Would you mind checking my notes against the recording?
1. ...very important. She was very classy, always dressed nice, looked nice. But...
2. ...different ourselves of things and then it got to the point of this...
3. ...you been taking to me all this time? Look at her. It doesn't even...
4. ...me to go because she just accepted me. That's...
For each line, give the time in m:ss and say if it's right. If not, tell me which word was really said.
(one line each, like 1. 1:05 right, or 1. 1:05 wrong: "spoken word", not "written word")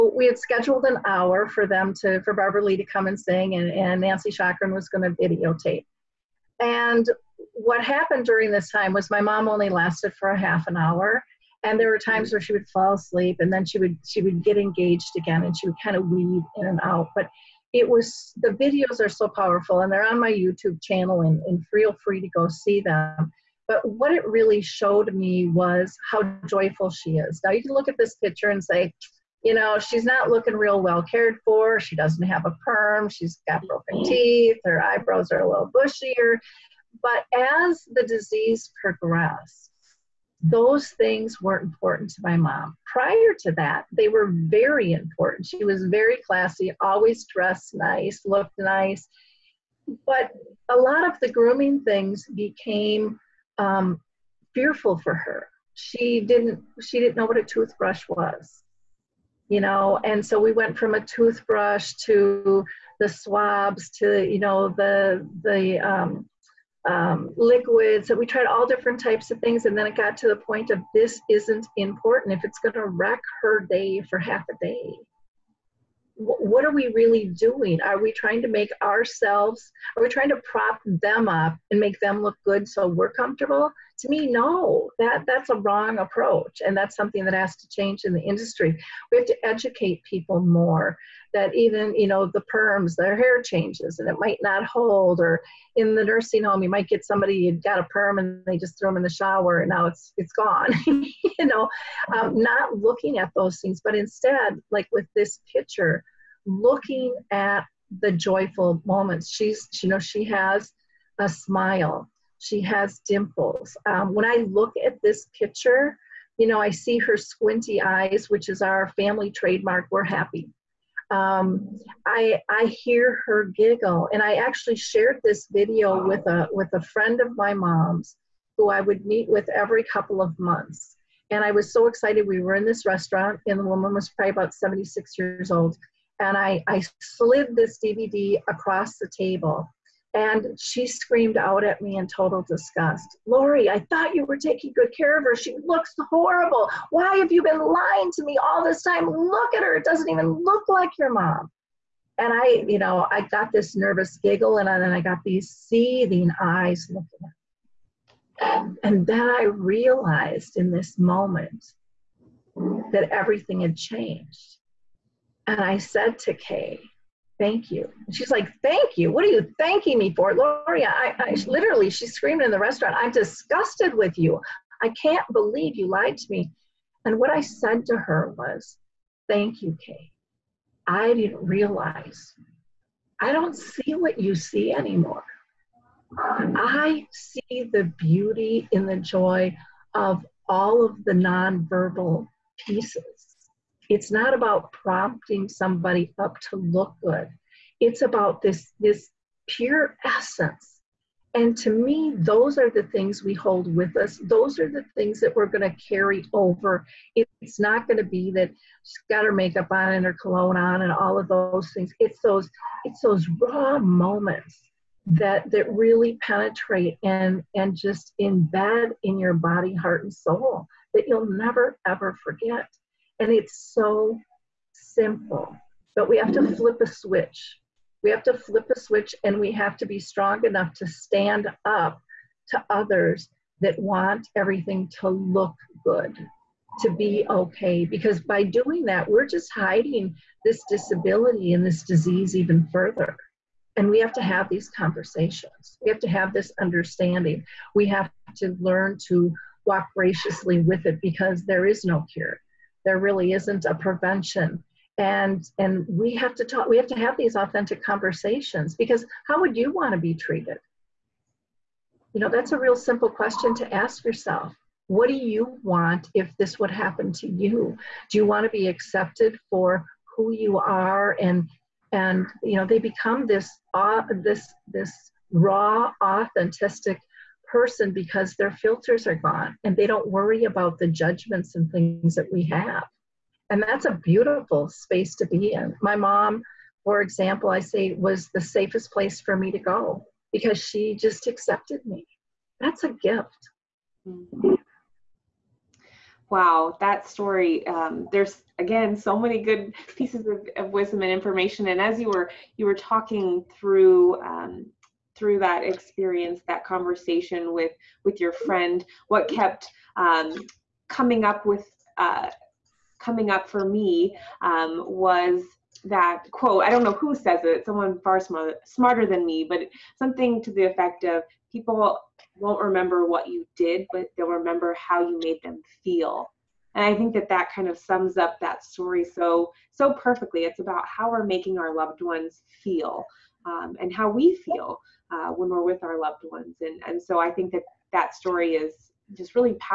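1. 0:44 right
2. 1:08 wrong: "types", not "ourselves"
3. 2:27 wrong: "lying", not "taking"
4. 4:49 right.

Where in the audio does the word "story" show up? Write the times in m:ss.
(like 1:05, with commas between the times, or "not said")
4:57, 5:28, 5:38.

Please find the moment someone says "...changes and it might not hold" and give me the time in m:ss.
1:33.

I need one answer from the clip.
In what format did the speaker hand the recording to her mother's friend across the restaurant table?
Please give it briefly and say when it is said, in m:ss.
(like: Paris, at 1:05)
DVD, at 2:17.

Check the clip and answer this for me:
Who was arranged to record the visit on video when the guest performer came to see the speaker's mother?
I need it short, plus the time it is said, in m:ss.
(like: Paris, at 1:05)
Nancy Chakran, at 0:04.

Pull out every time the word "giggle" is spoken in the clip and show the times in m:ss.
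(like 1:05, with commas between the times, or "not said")
2:03, 2:34.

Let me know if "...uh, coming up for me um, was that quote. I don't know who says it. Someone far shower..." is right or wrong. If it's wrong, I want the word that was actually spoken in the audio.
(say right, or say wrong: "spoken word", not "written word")
wrong: "smarter", not "shower".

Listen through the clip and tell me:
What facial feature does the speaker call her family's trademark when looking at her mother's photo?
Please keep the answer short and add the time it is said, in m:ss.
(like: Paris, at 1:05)
Squinty eyes, at 1:57.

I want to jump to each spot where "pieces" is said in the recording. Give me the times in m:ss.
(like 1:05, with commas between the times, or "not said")
3:12, 4:59.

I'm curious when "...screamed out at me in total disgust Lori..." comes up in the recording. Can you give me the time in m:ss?
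2:20.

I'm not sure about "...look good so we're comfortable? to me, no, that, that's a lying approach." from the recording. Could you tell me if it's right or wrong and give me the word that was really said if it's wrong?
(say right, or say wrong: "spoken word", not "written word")
wrong: "wrong", not "lying".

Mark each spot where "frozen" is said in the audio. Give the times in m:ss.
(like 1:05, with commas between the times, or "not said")
not said.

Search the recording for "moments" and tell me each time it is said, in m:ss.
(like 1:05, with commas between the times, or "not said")
1:48, 2:40, 3:33.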